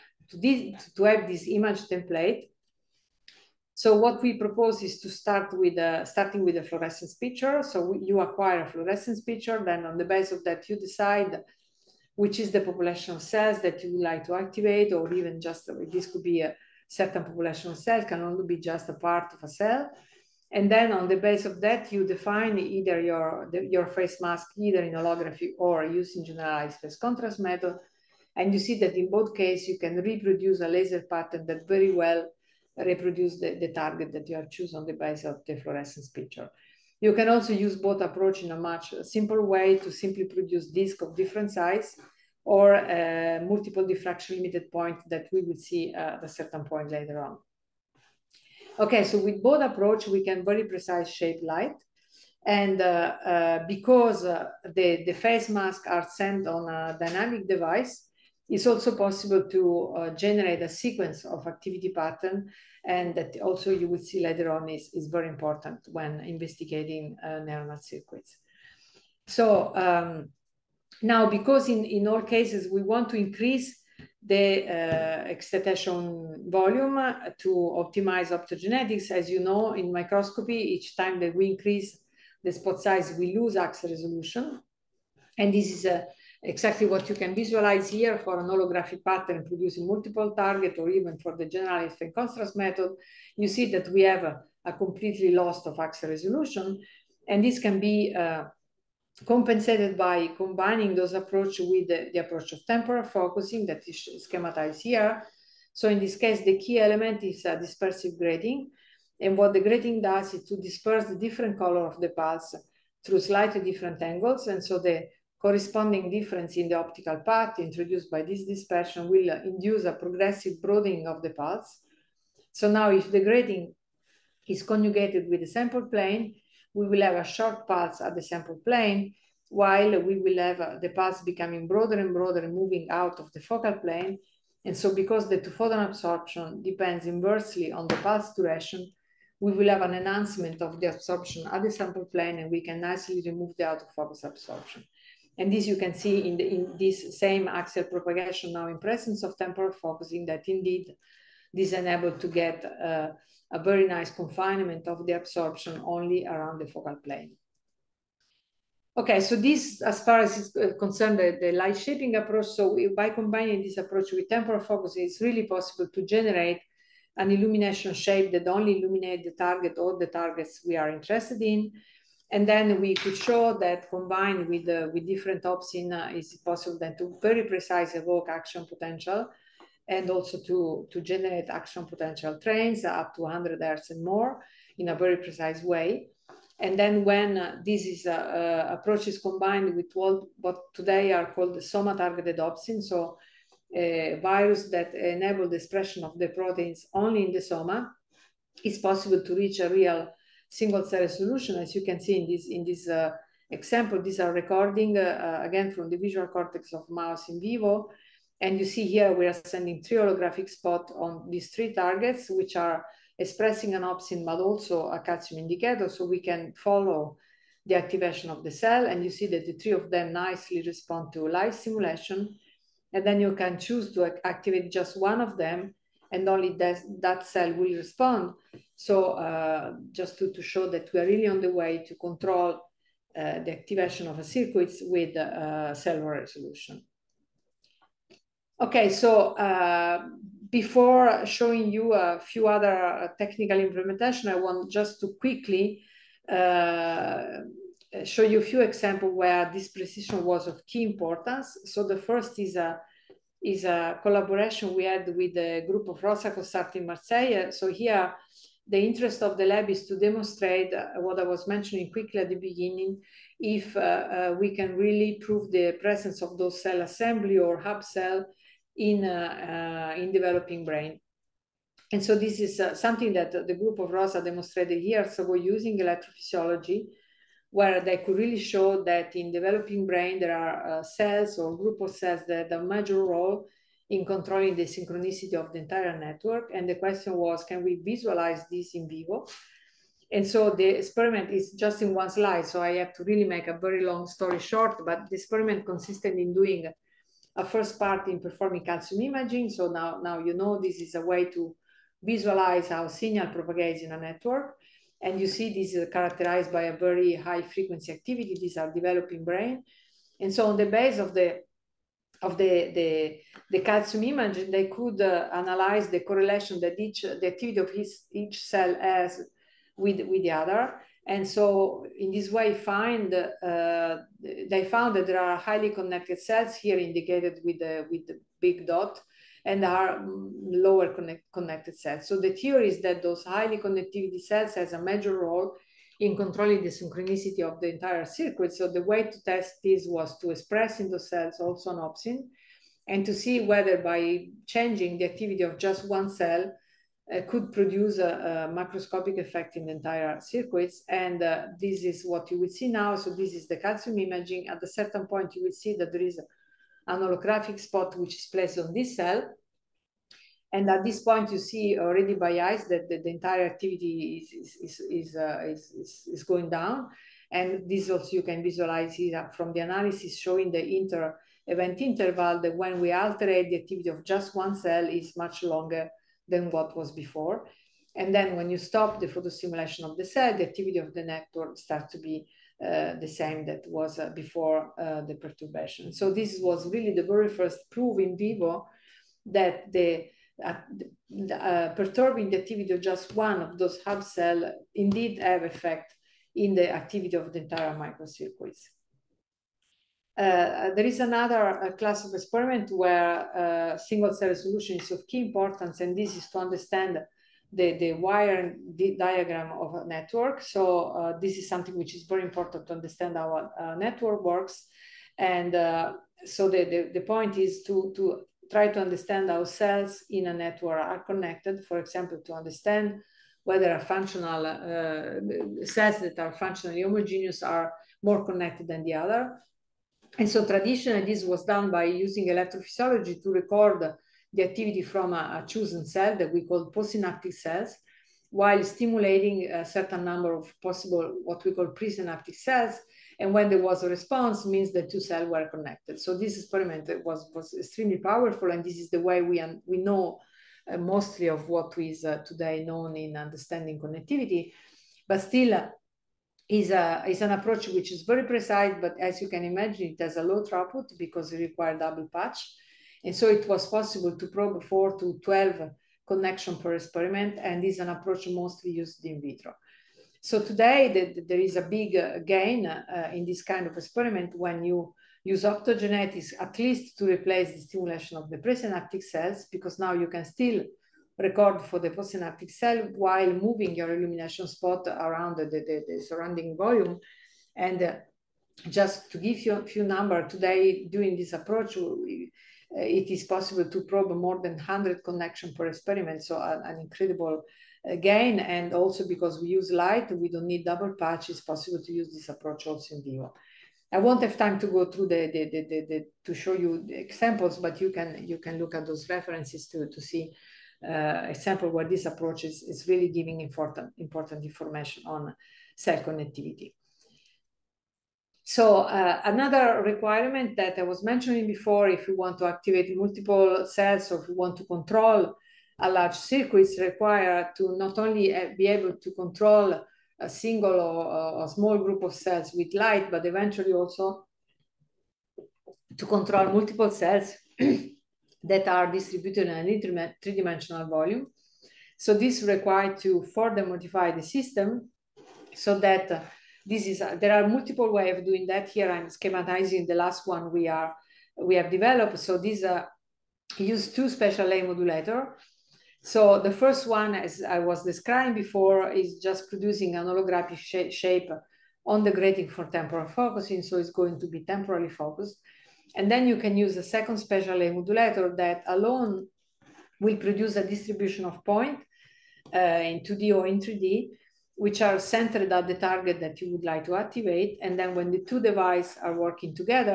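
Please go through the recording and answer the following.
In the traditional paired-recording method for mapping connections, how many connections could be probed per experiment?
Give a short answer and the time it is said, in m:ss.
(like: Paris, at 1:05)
4 to 12, at 7:44.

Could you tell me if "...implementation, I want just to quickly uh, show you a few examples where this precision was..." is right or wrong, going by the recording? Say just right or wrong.
right.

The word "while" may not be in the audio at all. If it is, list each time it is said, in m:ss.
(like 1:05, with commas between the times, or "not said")
2:09, 7:18, 8:02.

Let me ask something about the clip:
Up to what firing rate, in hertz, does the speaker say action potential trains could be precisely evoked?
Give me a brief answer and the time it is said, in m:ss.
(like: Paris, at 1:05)
100 hertz, at 3:03.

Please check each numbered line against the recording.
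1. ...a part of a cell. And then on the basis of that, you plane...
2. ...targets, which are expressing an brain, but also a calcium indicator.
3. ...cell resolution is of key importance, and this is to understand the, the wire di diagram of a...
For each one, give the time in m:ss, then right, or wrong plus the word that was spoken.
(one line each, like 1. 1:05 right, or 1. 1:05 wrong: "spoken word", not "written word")
1. 0:18 wrong: "define", not "plane"
2. 3:31 wrong: "opsin", not "brain"
3. 6:44 right.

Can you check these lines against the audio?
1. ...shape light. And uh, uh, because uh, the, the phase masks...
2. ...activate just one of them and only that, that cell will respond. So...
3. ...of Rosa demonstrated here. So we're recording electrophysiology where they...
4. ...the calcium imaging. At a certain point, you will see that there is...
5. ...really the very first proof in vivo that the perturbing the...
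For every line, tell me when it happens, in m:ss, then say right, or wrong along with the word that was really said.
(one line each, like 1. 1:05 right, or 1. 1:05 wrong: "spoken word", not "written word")
1. 0:51 right
2. 3:44 right
3. 4:33 wrong: "using", not "recording"
4. 5:53 right
5. 6:26 right.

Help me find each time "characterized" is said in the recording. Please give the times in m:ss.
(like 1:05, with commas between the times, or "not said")
5:05.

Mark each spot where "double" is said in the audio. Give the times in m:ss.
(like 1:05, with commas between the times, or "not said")
7:41, 8:20.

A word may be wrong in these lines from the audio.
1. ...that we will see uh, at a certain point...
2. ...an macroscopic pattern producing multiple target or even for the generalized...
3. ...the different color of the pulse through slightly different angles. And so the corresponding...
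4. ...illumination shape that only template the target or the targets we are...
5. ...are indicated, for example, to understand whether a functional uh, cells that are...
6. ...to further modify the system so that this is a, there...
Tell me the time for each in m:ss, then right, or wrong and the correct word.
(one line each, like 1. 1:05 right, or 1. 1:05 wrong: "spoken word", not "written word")
1. 0:45 right
2. 1:28 wrong: "holographic", not "macroscopic"
3. 1:51 right
4. 2:47 wrong: "illuminate", not "template"
5. 7:00 wrong: "connected", not "indicated"
6. 9:03 right.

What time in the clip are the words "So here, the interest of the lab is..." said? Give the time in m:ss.
4:17.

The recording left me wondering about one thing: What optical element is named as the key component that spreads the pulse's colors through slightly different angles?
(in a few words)
Dispersive grating.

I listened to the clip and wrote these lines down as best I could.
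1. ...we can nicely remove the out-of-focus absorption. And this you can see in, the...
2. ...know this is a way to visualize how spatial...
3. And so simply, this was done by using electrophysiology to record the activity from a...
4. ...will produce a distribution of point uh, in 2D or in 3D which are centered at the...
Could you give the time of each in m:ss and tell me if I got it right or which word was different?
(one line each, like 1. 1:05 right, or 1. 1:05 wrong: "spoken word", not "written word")
1. 2:22 right
2. 5:00 wrong: "signal", not "spatial"
3. 7:10 wrong: "traditionally", not "simply"
4. 9:29 right.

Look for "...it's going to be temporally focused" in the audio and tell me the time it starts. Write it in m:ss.
9:23.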